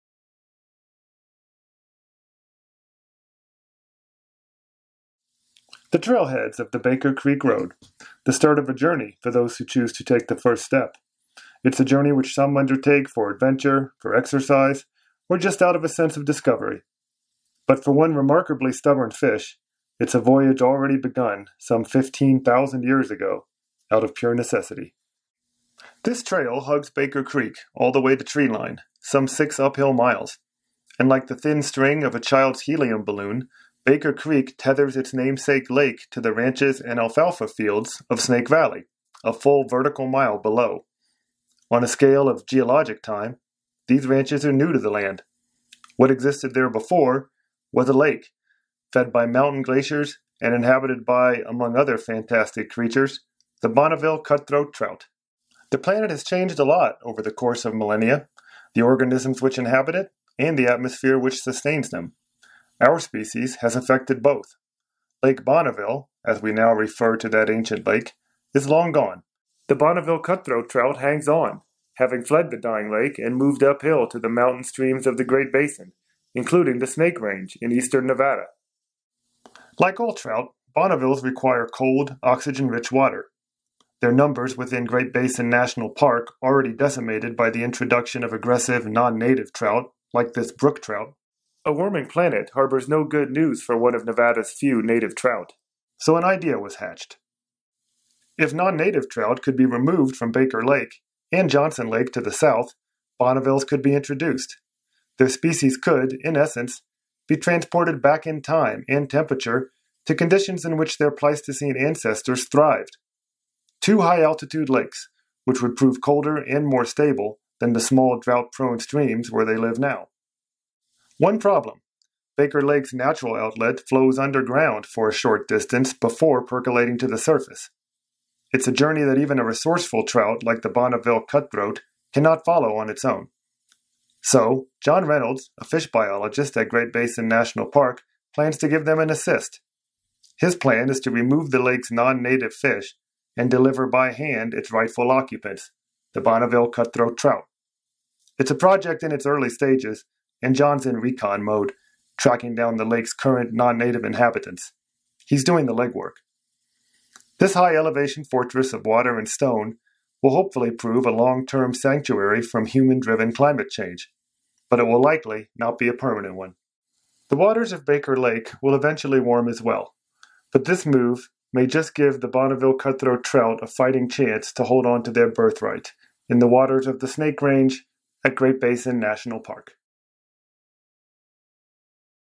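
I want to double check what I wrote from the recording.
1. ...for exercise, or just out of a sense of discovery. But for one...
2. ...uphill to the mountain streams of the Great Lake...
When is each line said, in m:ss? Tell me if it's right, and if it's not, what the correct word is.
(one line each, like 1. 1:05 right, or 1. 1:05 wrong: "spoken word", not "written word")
1. 0:13 right
2. 1:13 wrong: "Basin", not "Lake".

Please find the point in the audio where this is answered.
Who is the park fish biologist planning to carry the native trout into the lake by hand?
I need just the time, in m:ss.
2:14.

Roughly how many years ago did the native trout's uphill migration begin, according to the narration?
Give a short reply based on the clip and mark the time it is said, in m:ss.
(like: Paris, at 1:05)
15,000, at 0:21.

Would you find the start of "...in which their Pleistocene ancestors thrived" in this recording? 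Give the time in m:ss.
1:50.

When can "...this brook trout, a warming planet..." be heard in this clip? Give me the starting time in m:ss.
1:30.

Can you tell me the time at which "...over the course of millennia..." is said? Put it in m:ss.
0:57.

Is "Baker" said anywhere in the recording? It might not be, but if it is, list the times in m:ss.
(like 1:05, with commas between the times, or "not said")
0:06, 0:26, 0:33, 1:40, 2:02, 2:47.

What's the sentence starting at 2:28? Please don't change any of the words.
It's a project in its early stages, and John's in recon mode, tracking down the lake's current non native inhabitants.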